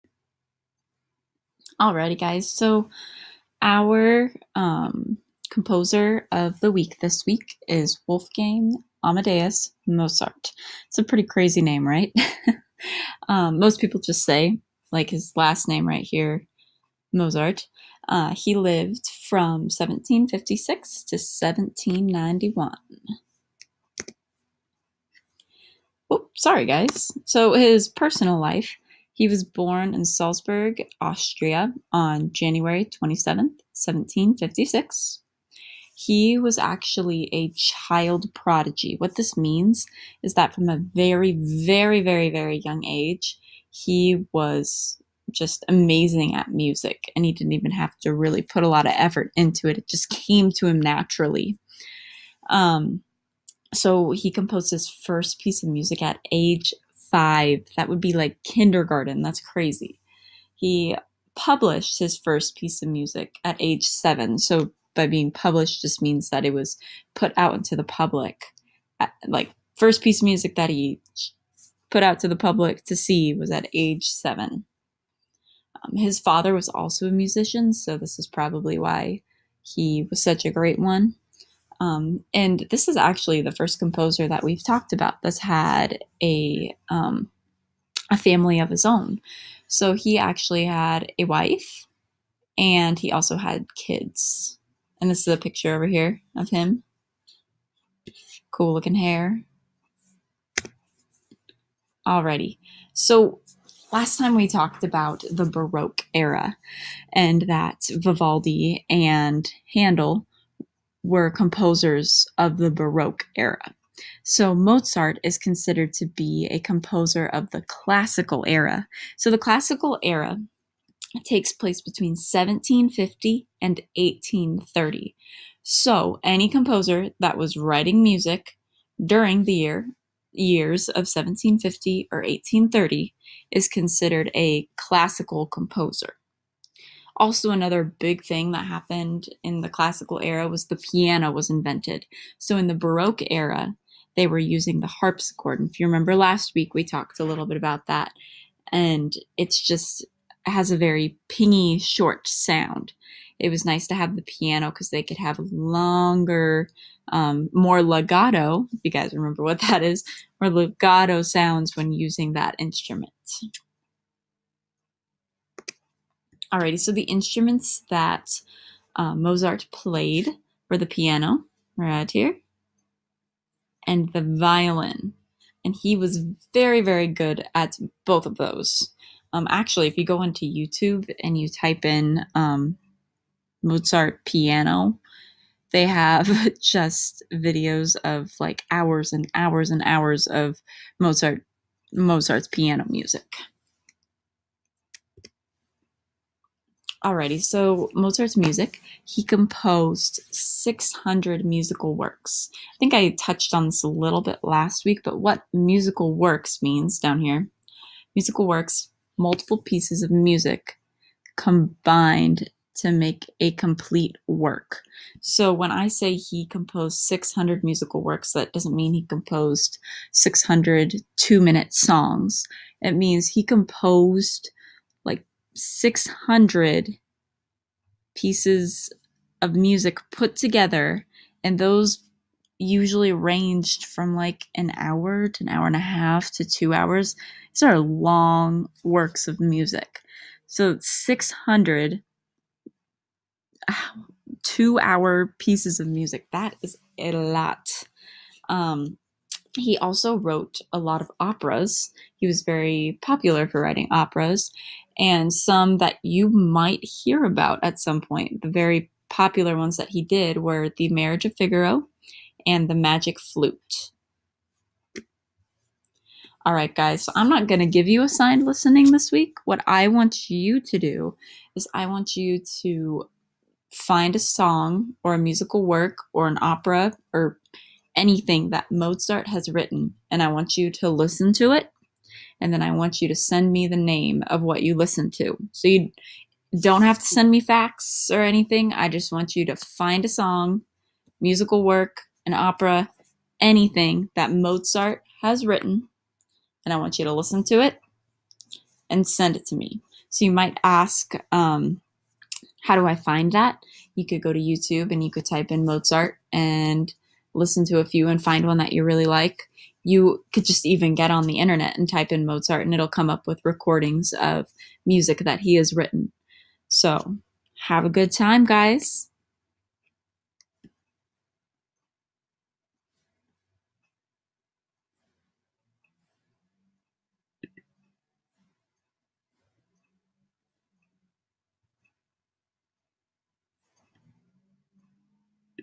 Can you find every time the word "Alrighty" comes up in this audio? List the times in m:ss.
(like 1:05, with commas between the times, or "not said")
0:01, 1:42, 2:46, 3:17.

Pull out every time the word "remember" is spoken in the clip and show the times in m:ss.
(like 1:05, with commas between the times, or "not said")
2:25, 2:39.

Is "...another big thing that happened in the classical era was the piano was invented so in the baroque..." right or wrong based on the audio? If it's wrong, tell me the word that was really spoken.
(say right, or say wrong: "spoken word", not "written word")
right.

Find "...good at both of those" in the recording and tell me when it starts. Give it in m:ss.
2:57.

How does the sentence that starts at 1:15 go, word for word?
Um, his father was also a musician, so this is probably why he was such a great one.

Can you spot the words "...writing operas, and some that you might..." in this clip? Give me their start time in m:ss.
4:13.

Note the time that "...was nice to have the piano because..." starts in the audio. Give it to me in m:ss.
2:33.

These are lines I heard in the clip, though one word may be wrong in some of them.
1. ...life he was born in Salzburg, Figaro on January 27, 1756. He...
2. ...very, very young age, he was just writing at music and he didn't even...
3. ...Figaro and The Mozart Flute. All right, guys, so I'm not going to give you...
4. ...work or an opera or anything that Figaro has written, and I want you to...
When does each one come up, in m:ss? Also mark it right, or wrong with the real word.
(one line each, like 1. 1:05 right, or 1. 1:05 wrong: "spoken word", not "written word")
1. 0:28 wrong: "Austria", not "Figaro"
2. 0:42 wrong: "amazing", not "writing"
3. 4:21 wrong: "Magic", not "Mozart"
4. 4:35 wrong: "Mozart", not "Figaro".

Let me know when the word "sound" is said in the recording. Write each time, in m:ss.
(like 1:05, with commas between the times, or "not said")
2:32, 2:41.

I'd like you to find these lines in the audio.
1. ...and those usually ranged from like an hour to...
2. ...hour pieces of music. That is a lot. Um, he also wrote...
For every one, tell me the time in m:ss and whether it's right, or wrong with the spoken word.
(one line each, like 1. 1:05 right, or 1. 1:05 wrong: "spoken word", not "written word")
1. 3:51 right
2. 4:04 right.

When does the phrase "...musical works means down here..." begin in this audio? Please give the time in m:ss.
3:25.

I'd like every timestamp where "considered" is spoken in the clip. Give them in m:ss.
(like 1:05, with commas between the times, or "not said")
1:55, 2:13.